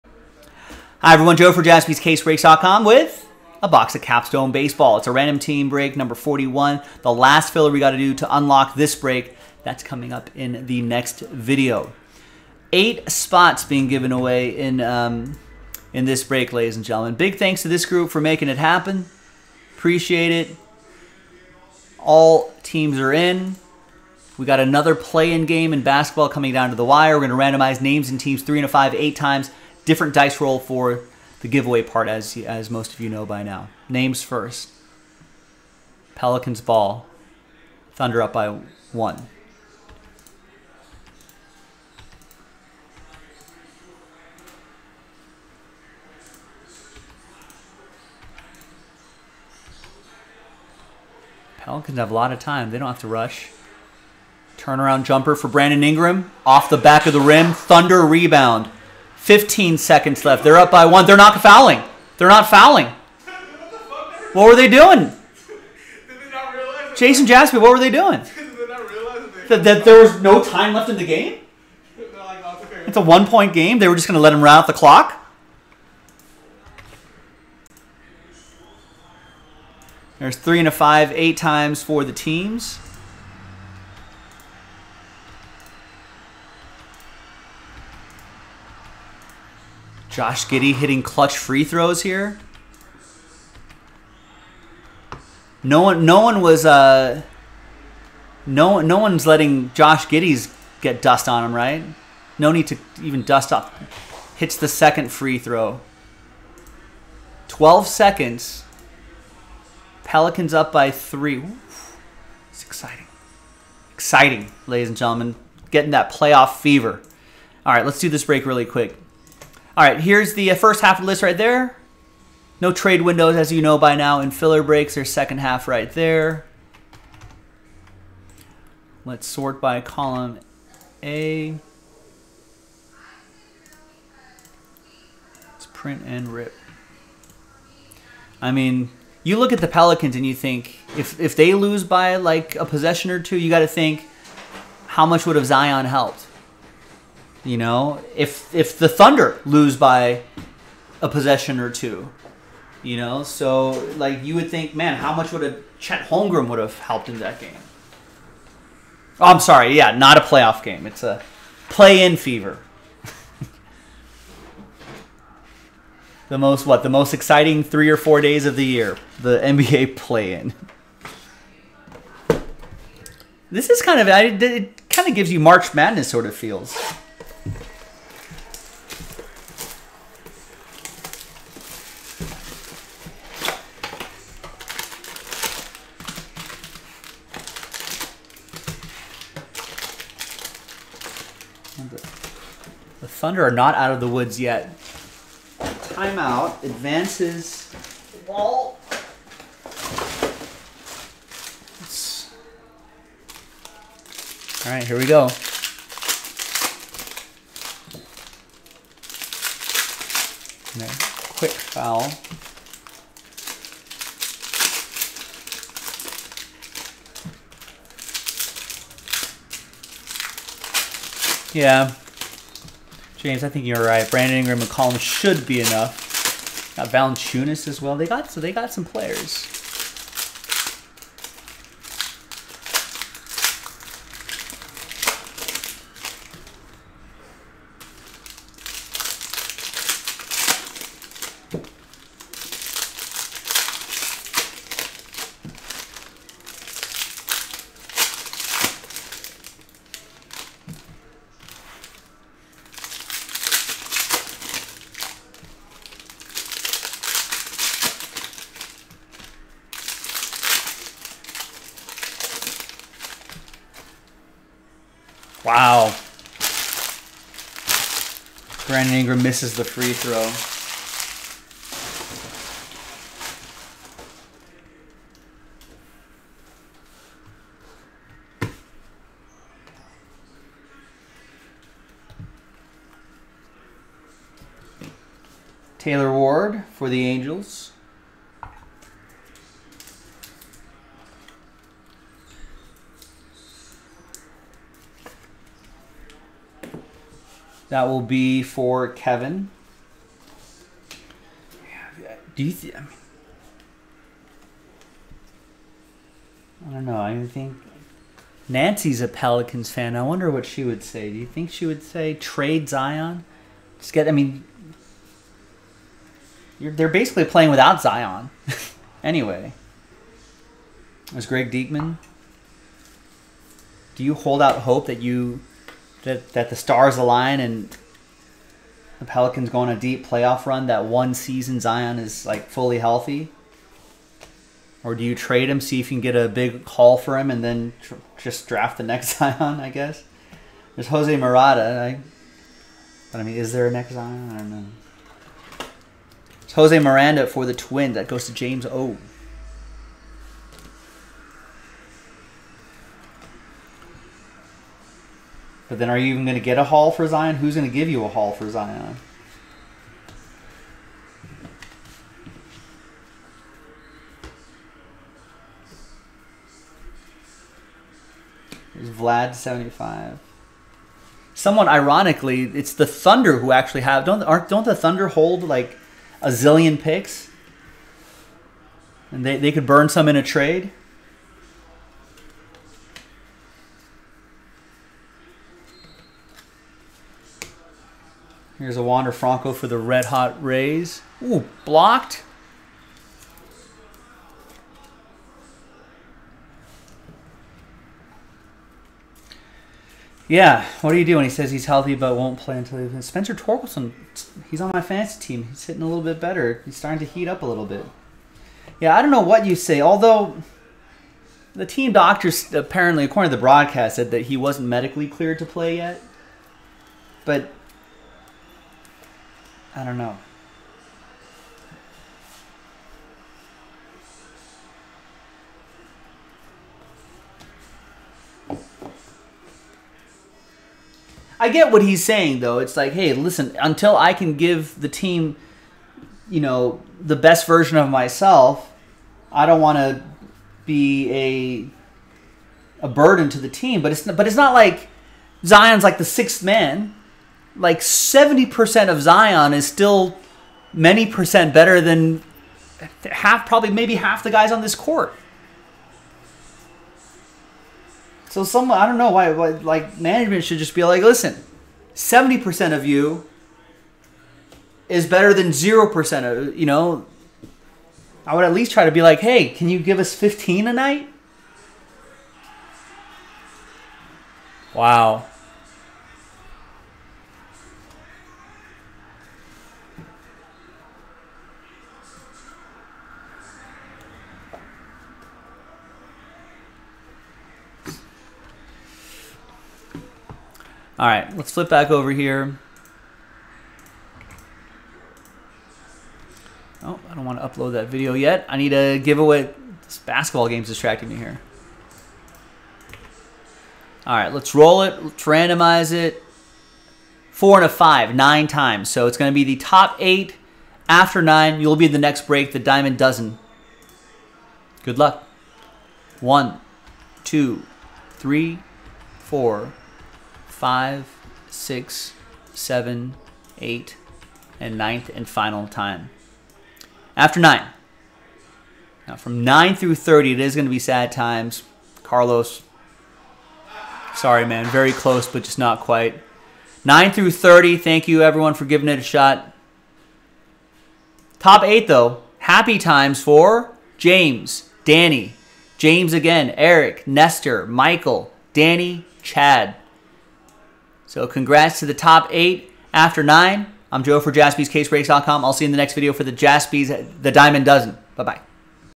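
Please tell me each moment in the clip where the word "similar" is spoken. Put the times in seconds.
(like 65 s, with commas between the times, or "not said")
not said.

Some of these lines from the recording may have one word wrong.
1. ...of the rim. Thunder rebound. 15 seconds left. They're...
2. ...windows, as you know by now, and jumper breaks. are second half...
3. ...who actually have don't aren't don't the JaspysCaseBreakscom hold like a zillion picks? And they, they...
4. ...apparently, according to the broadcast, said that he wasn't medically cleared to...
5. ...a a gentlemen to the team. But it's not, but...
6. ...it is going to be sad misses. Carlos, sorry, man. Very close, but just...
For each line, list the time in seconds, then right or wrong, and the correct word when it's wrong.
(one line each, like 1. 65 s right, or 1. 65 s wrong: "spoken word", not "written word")
1. 57 s right
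2. 123 s wrong: "filler", not "jumper"
3. 373 s wrong: "Thunder", not "JaspysCaseBreakscom"
4. 412 s right
5. 441 s wrong: "burden", not "gentlemen"
6. 530 s wrong: "times", not "misses".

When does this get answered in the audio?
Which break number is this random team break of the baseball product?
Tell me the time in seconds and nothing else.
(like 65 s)
5 s.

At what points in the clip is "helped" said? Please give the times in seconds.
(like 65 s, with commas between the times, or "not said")
145 s, 156 s.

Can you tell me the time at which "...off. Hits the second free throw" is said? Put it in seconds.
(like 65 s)
103 s.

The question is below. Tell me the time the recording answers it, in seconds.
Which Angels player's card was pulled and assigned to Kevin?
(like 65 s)
285 s.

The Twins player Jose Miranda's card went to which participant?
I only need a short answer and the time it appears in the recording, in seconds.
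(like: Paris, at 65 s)
James O, at 348 s.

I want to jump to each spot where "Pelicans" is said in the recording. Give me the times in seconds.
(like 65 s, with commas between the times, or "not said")
36 s, 51 s, 110 s, 139 s, 309 s, 329 s.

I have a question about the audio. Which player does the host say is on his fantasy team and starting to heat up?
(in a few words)
Spencer Torkelson.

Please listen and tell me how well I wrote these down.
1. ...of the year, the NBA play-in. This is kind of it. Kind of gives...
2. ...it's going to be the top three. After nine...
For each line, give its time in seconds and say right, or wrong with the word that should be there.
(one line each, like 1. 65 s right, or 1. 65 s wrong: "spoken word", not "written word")
1. 168 s right
2. 509 s wrong: "eight", not "three".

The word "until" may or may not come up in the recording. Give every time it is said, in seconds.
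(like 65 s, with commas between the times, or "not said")
402 s, 433 s.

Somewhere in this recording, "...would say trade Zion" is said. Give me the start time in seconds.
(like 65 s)
311 s.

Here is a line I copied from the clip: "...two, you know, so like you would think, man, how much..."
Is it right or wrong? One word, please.
right.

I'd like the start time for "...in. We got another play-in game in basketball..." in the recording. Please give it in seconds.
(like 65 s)
23 s.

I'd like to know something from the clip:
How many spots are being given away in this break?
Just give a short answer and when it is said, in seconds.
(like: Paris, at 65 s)
8, at 12 s.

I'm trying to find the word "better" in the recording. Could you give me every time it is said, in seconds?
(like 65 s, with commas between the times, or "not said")
406 s, 451 s, 465 s.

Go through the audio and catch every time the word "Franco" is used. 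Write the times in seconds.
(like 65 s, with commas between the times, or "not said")
389 s.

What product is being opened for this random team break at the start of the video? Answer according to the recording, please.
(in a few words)
Capstone Baseball.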